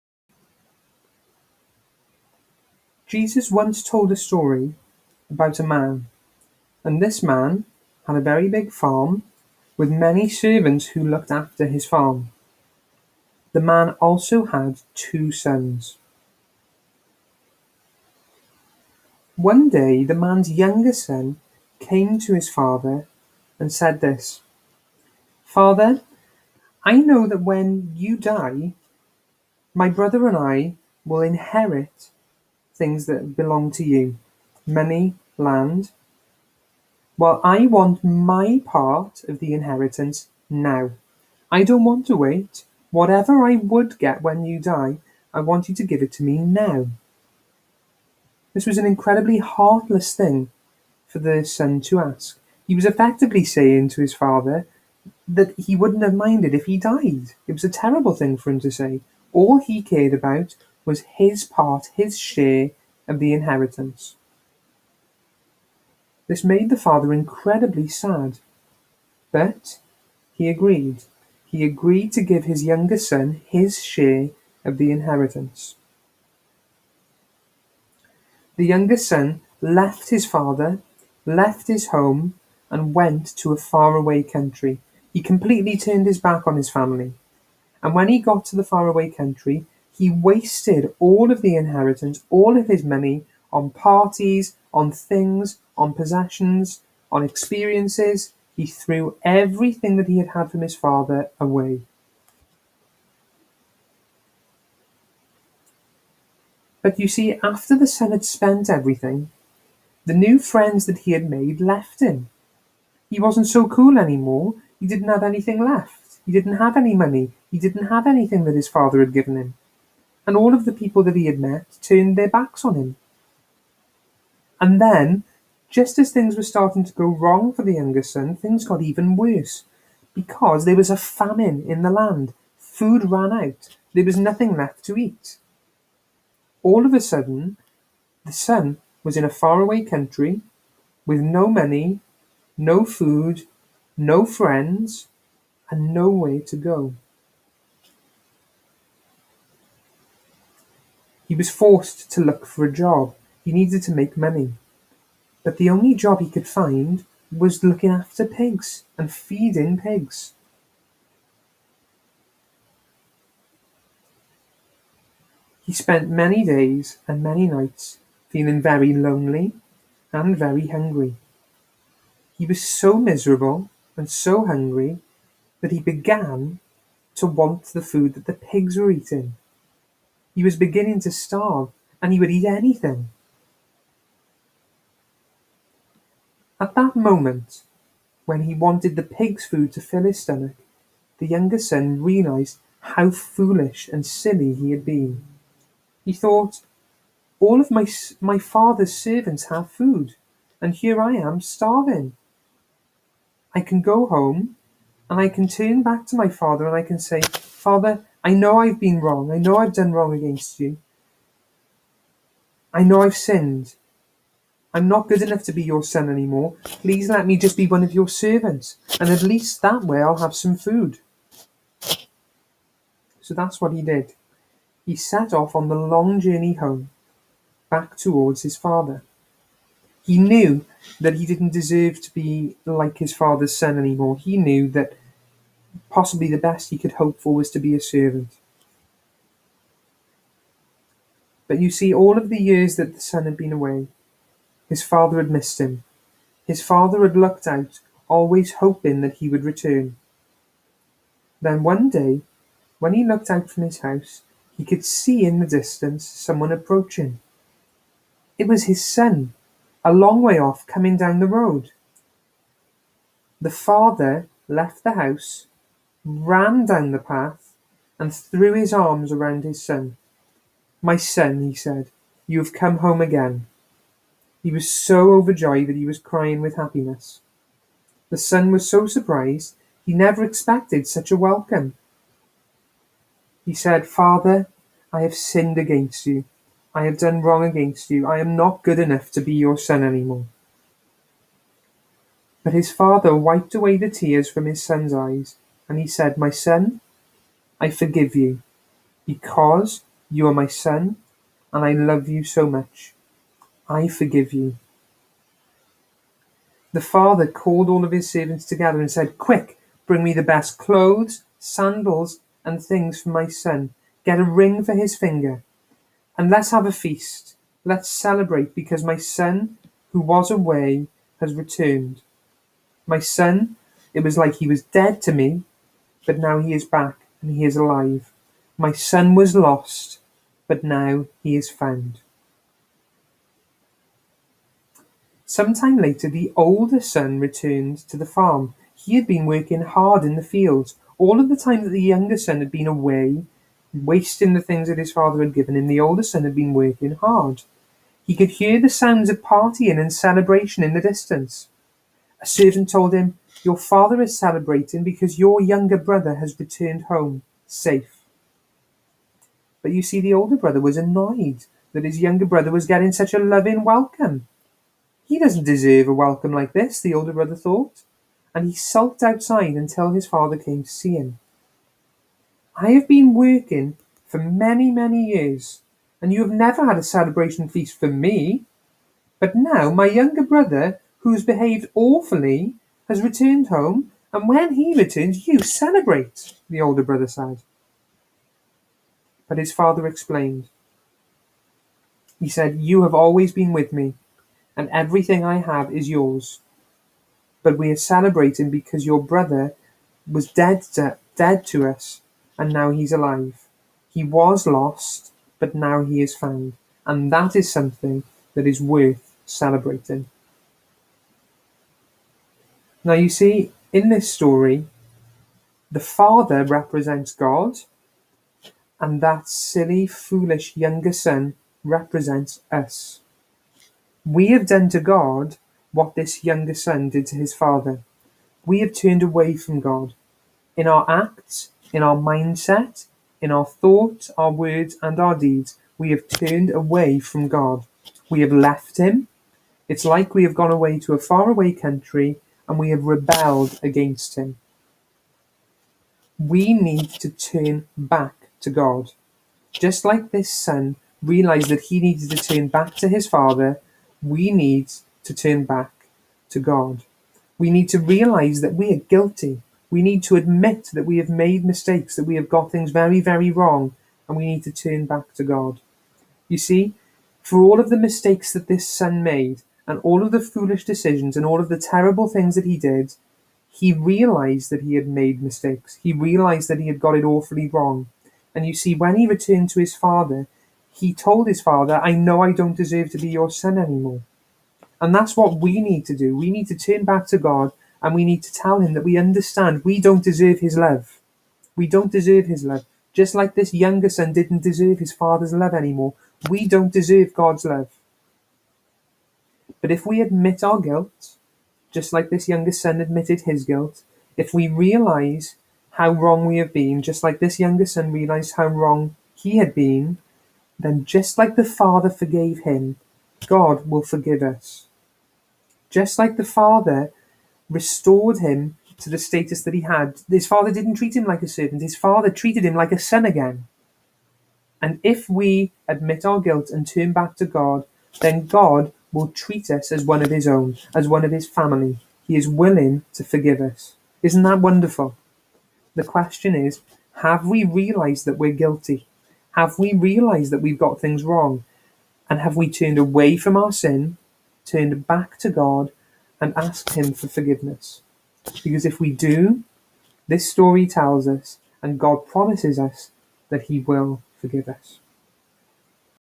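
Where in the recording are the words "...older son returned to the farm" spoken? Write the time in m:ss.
5:36.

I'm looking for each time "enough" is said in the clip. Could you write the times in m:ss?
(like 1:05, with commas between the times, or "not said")
3:35, 4:48.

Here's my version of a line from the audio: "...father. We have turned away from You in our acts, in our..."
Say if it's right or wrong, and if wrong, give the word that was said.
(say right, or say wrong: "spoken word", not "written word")
wrong: "God", not "You".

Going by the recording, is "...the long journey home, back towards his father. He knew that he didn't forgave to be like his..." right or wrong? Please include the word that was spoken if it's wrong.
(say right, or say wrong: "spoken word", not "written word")
wrong: "deserve", not "forgave".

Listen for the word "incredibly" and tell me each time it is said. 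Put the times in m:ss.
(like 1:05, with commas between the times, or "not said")
0:48, 1:07.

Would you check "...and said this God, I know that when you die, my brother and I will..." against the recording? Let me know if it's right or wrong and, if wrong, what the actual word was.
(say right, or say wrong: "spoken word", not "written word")
wrong: "Father", not "God".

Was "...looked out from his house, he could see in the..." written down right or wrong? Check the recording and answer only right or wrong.
right.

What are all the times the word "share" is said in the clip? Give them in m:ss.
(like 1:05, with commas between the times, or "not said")
1:02, 1:13.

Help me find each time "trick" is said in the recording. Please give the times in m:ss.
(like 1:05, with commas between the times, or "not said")
not said.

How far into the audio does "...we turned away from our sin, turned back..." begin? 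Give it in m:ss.
9:02.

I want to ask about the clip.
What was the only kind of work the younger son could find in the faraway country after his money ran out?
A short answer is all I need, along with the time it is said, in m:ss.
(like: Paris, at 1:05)
Looking after pigs, at 2:37.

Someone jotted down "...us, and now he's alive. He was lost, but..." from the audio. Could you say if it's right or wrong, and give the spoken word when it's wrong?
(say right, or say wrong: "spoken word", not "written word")
right.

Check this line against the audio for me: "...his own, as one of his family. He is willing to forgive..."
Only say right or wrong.
right.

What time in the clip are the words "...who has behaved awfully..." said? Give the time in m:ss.
6:20.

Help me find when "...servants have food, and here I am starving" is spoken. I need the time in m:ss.
3:18.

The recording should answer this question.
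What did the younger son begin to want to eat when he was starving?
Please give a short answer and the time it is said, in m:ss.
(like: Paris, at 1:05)
The pigs' food, at 2:57.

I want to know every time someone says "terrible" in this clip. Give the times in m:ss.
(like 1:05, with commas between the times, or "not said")
0:57, 7:51.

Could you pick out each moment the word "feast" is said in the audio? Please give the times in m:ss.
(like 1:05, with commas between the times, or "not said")
5:16, 6:17.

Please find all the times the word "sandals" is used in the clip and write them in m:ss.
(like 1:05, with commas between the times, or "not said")
5:11.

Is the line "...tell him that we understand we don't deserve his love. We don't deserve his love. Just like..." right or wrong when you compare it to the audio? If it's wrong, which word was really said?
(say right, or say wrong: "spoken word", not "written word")
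right.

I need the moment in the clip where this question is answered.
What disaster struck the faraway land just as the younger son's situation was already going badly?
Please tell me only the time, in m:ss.
2:10.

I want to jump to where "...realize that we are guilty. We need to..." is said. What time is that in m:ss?
7:37.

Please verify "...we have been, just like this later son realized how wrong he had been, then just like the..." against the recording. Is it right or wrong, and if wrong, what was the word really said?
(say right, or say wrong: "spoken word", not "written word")
wrong: "younger", not "later".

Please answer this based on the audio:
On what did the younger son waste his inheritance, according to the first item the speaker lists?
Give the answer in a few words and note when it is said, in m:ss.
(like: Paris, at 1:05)
Parties, at 1:33.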